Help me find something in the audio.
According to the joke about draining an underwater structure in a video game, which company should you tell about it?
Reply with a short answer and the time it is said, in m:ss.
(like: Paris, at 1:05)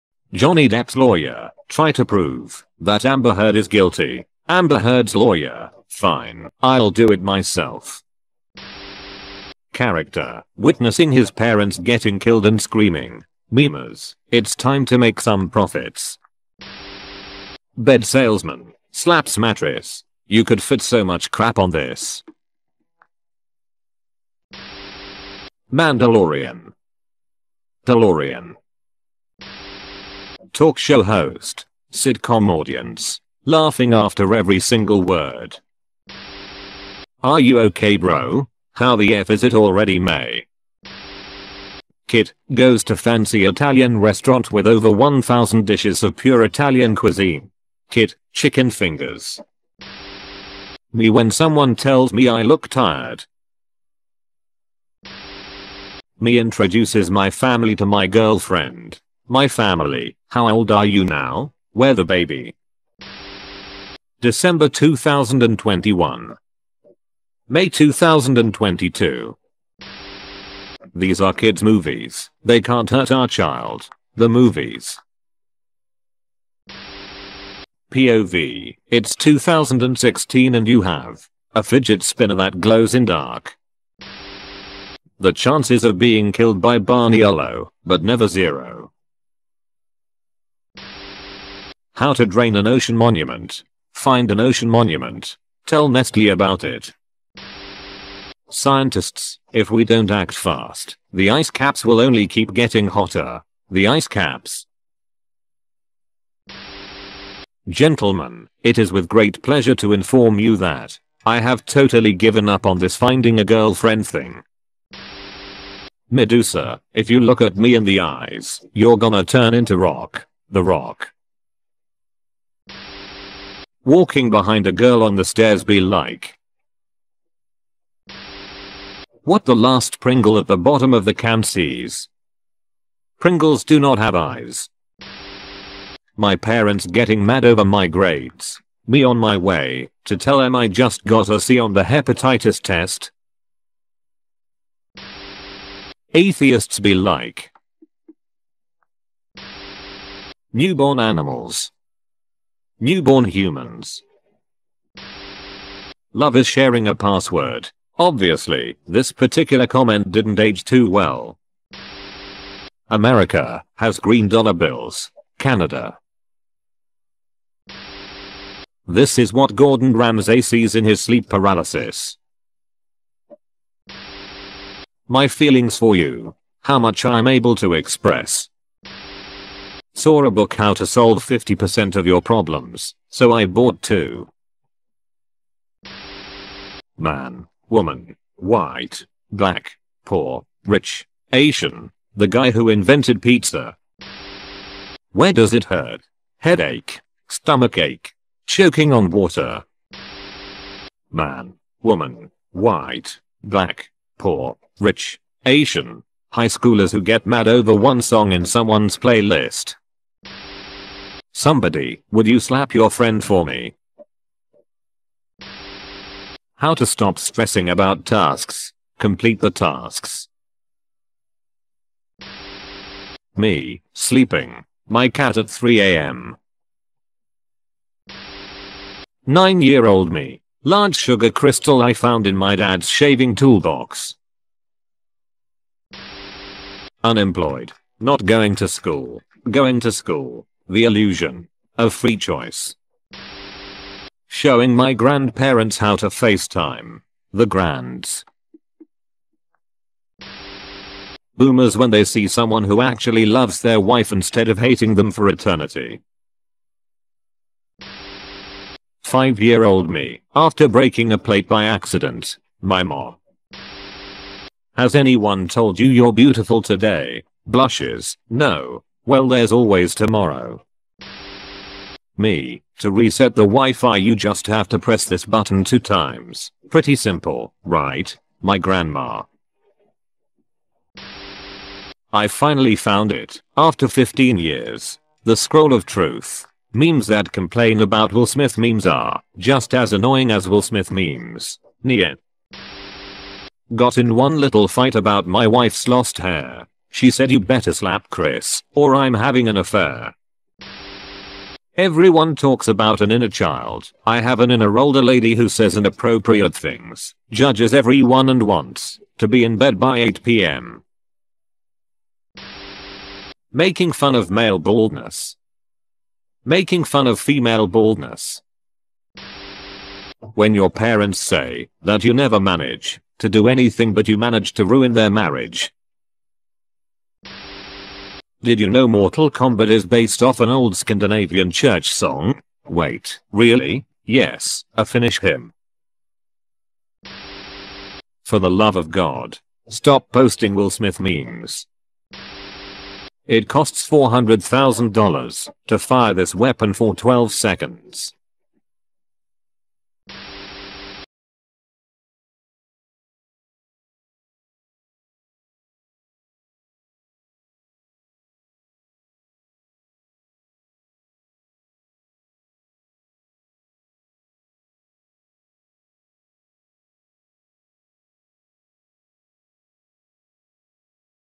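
Nestle, at 1:35.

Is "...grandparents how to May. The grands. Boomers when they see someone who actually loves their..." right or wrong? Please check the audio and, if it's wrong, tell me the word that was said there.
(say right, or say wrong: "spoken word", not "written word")
wrong: "FaceTime", not "May".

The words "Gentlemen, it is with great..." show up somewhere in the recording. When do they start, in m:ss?
1:47.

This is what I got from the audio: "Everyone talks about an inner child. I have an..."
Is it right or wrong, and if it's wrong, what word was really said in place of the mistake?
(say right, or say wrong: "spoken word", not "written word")
right.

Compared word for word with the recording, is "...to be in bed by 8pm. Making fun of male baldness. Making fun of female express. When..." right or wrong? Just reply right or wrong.
wrong.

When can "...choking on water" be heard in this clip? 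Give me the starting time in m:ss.
3:18.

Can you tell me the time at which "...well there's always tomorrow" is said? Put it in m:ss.
4:29.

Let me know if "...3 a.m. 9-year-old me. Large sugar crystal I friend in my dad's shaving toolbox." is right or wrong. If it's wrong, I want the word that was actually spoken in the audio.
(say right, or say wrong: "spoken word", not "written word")
wrong: "found", not "friend".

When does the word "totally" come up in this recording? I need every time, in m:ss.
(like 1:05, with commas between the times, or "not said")
1:51.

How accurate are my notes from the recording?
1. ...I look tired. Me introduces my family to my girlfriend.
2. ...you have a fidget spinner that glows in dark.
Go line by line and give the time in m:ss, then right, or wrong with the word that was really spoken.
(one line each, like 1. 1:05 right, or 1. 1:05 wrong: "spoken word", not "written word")
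1. 0:52 right
2. 1:20 right.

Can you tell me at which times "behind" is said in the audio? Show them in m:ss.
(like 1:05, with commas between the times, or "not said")
2:04.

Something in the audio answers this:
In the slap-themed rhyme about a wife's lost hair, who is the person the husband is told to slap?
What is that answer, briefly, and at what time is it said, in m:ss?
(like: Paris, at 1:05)
Chris, at 4:58.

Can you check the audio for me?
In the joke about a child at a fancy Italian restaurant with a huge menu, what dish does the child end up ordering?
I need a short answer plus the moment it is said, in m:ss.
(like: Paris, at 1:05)
Chicken fingers, at 0:48.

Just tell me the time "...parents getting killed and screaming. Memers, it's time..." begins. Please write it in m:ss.
0:11.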